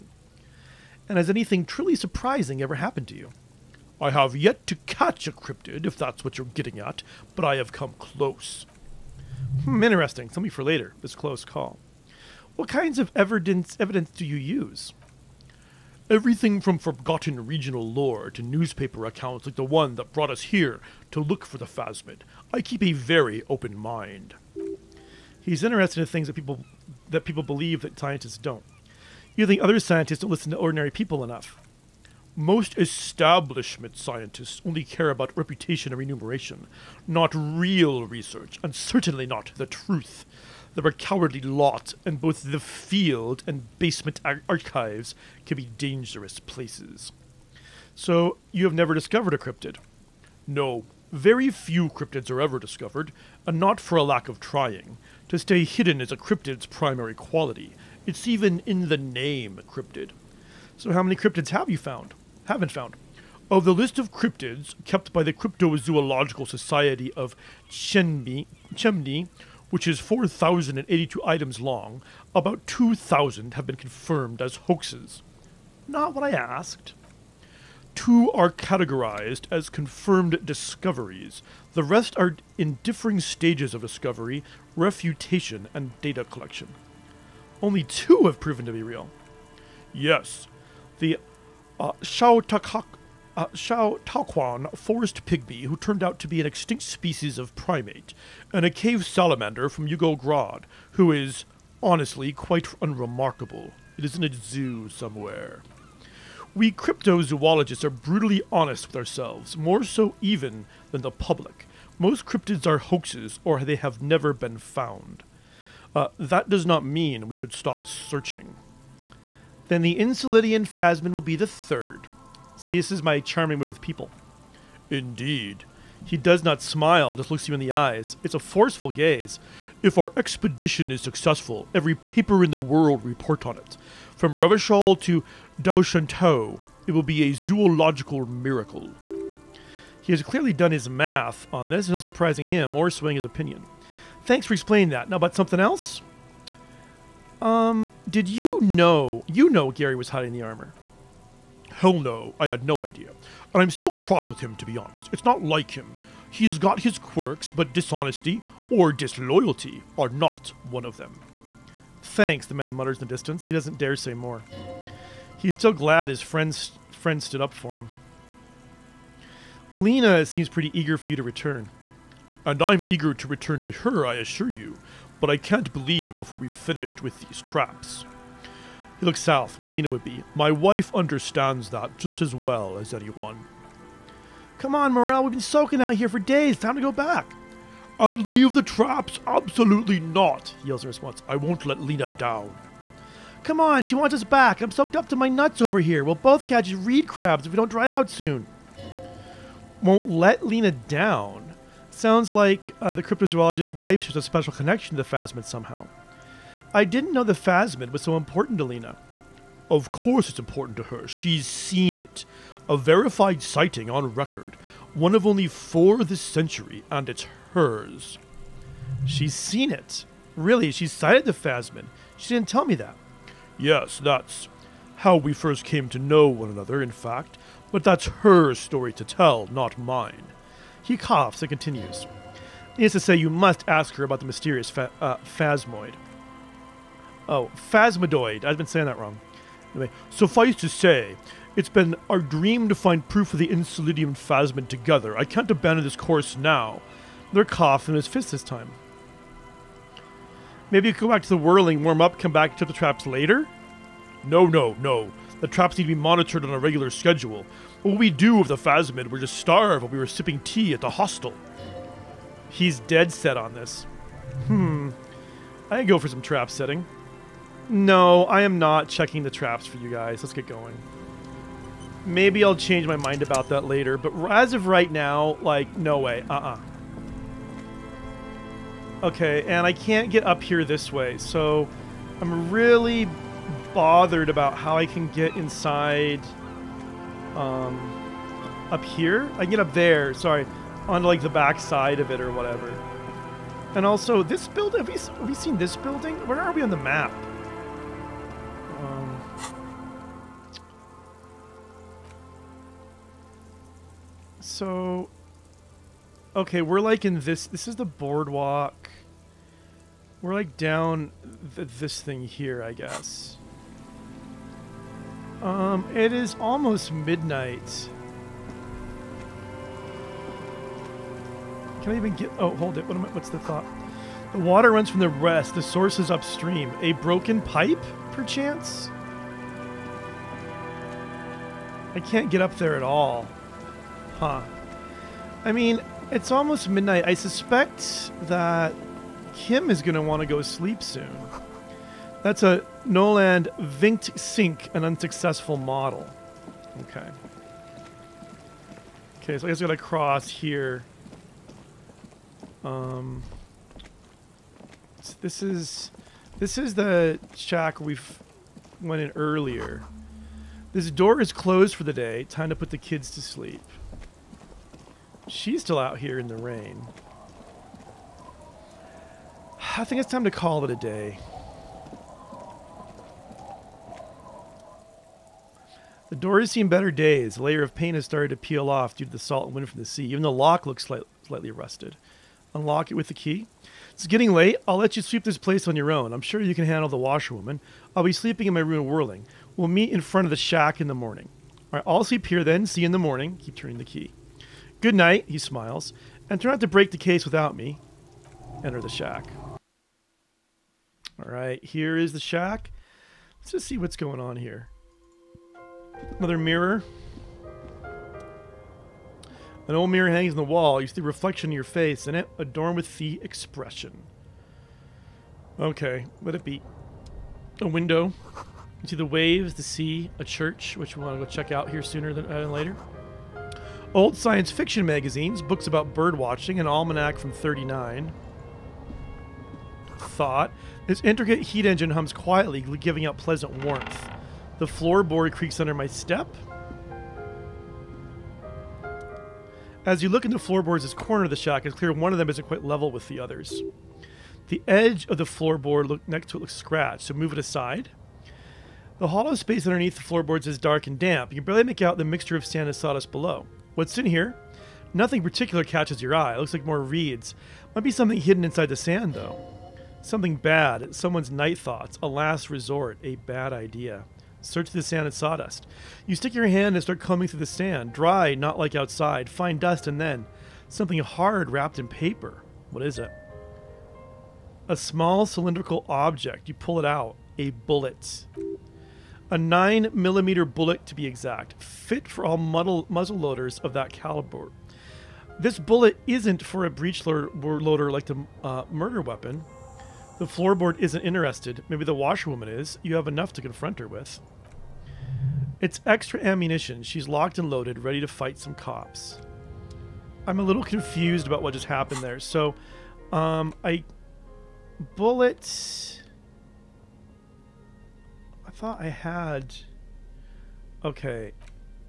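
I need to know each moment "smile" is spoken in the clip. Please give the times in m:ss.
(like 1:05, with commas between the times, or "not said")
2:06, 6:35.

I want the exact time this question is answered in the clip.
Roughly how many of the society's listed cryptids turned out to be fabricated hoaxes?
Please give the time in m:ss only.
1:12.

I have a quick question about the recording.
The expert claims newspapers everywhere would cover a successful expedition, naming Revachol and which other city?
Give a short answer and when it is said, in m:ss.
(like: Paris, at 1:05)
Daoshantou, at 2:15.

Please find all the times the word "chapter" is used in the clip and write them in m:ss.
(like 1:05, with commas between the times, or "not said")
not said.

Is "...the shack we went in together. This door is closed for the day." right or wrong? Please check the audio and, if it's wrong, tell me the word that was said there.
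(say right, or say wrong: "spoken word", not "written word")
wrong: "earlier", not "together".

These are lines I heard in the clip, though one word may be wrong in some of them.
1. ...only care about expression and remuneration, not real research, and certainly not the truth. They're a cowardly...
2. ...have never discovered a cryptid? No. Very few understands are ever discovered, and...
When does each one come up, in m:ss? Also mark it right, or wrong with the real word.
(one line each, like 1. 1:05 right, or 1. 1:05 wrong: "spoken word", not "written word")
1. 0:34 wrong: "reputation", not "expression"
2. 0:48 wrong: "cryptids", not "understands".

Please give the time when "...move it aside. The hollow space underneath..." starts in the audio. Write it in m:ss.
7:27.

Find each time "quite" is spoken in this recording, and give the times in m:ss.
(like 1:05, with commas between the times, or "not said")
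1:42, 7:22.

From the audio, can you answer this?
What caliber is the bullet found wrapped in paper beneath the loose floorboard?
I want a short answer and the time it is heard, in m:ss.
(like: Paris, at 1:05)
9 millimeter, at 7:59.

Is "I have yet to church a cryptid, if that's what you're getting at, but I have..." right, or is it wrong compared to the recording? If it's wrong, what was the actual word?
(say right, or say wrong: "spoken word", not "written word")
wrong: "catch", not "church".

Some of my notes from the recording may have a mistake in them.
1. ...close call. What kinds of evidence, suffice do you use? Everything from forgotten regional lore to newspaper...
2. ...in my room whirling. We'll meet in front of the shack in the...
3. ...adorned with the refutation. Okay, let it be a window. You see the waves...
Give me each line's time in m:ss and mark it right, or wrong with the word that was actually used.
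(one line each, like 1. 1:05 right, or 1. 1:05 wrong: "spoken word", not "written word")
1. 0:11 wrong: "evidence", not "suffice"
2. 6:28 right
3. 6:52 wrong: "expression", not "refutation".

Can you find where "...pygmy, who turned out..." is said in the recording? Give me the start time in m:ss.
1:35.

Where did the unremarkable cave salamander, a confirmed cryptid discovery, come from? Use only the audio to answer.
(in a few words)
Yugograd.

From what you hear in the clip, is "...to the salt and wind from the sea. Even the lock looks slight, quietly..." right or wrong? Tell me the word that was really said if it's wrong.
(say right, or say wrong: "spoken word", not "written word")
wrong: "slightly", not "quietly".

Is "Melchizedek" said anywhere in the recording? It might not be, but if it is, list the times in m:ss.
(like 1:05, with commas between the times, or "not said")
not said.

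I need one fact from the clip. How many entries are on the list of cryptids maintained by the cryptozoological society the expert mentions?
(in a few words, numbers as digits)
4,082.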